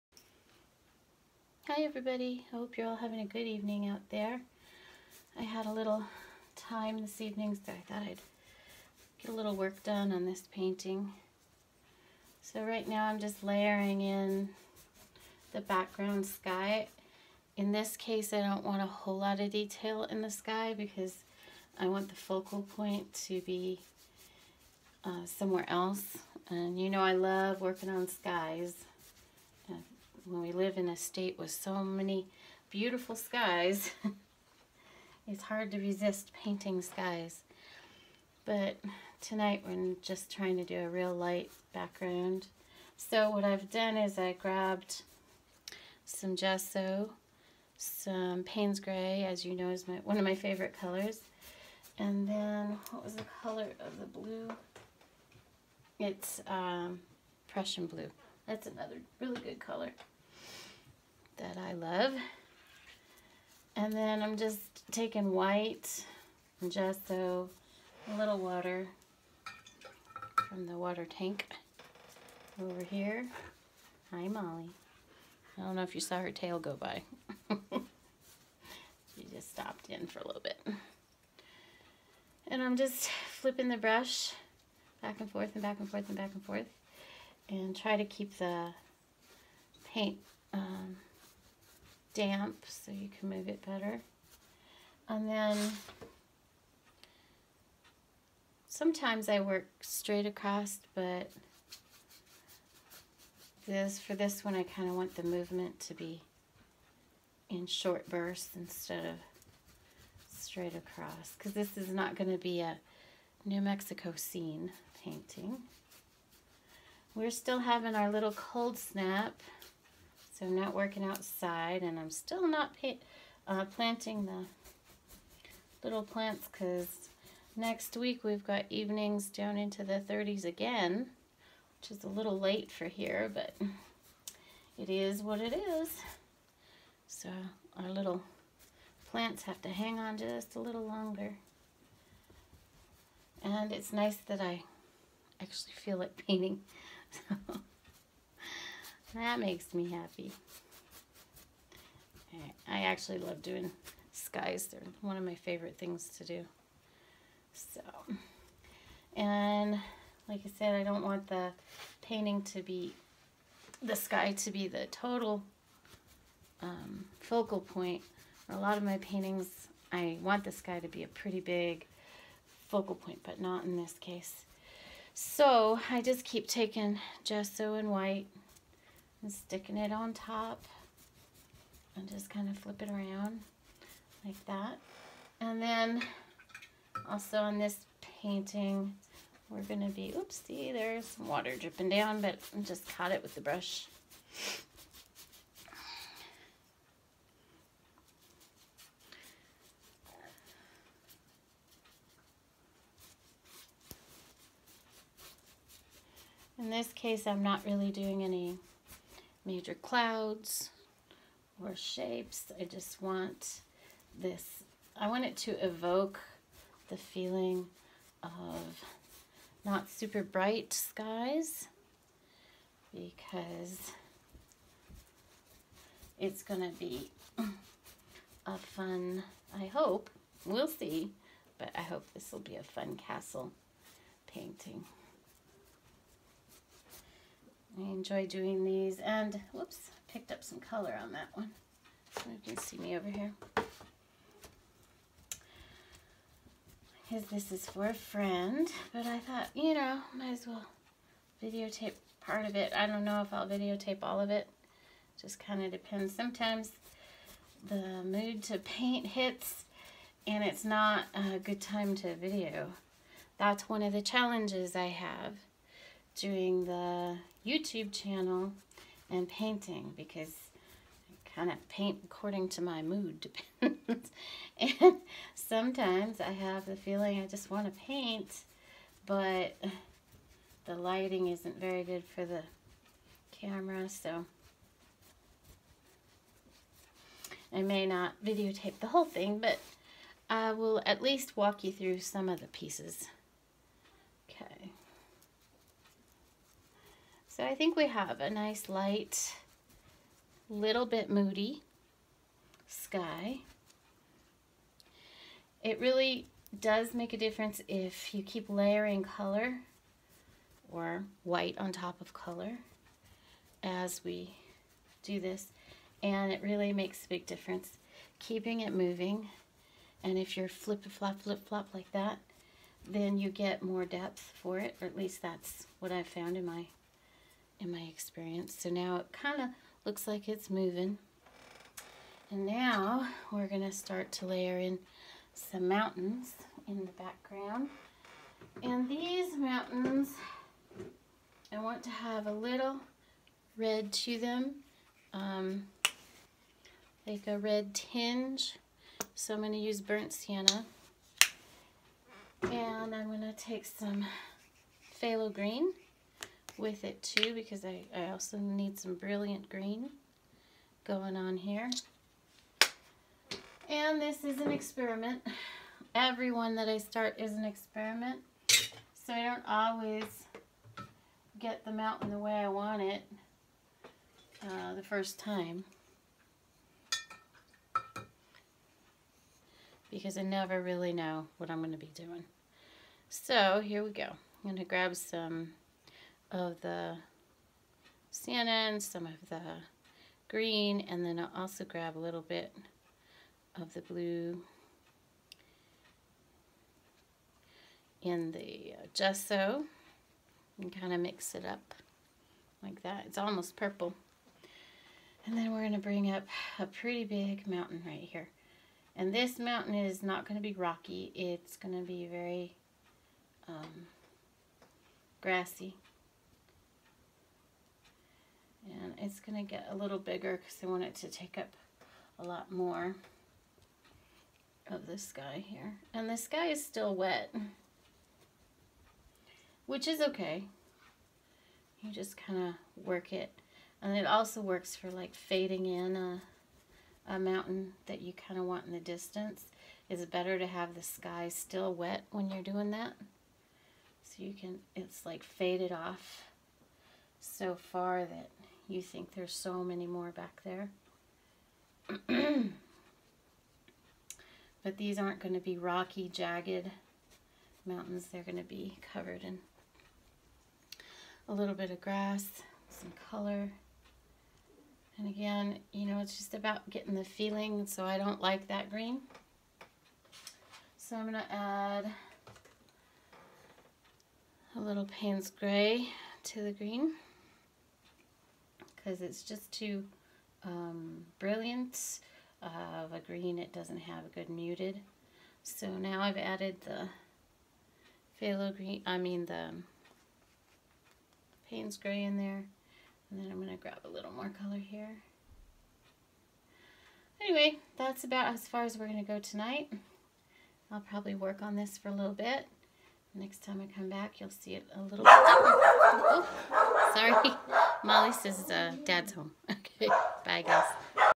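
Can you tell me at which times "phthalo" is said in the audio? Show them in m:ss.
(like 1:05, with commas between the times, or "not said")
5:54, 8:08.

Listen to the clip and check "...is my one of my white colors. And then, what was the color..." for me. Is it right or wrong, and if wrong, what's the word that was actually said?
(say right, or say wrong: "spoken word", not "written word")
wrong: "favorite", not "white".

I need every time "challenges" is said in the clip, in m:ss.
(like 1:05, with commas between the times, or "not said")
4:24.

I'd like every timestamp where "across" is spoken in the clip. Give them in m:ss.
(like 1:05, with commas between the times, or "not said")
1:40, 1:50.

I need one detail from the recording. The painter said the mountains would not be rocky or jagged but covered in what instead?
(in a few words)
grass.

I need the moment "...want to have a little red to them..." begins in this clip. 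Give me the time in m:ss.
5:41.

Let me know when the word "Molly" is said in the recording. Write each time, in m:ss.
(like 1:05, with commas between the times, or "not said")
1:14, 8:27.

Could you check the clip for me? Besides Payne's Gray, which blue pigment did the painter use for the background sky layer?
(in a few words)
Prussian blue.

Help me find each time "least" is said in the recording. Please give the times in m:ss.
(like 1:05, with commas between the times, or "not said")
4:51, 5:24.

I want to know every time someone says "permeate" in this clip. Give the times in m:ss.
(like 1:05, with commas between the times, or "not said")
not said.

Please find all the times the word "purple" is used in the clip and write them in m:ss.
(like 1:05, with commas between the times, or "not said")
6:43.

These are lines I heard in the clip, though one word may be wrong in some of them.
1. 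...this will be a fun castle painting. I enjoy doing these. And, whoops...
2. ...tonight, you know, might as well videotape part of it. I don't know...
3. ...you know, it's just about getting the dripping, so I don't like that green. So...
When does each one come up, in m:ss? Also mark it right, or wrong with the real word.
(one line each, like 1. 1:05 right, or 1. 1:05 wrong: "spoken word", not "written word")
1. 3:52 right
2. 4:09 wrong: "thought", not "tonight"
3. 7:45 wrong: "feeling", not "dripping".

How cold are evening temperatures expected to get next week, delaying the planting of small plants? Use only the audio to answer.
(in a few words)
the 30s.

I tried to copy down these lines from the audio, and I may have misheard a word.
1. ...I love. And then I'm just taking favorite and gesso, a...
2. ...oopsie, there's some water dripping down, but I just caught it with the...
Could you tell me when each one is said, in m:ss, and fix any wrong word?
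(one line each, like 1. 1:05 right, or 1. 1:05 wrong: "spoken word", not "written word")
1. 1:01 wrong: "white", not "favorite"
2. 3:10 right.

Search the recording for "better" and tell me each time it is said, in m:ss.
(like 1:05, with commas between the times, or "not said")
1:33, 7:20.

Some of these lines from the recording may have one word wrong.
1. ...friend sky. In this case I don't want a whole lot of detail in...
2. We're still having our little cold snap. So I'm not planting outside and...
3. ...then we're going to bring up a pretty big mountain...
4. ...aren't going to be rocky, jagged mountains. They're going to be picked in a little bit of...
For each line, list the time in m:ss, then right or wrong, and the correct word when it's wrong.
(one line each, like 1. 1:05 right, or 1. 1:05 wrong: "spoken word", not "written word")
1. 0:15 wrong: "background", not "friend"
2. 1:57 wrong: "working", not "planting"
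3. 6:45 right
4. 7:34 wrong: "covered", not "picked".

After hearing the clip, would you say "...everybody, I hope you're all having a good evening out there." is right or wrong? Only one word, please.
right.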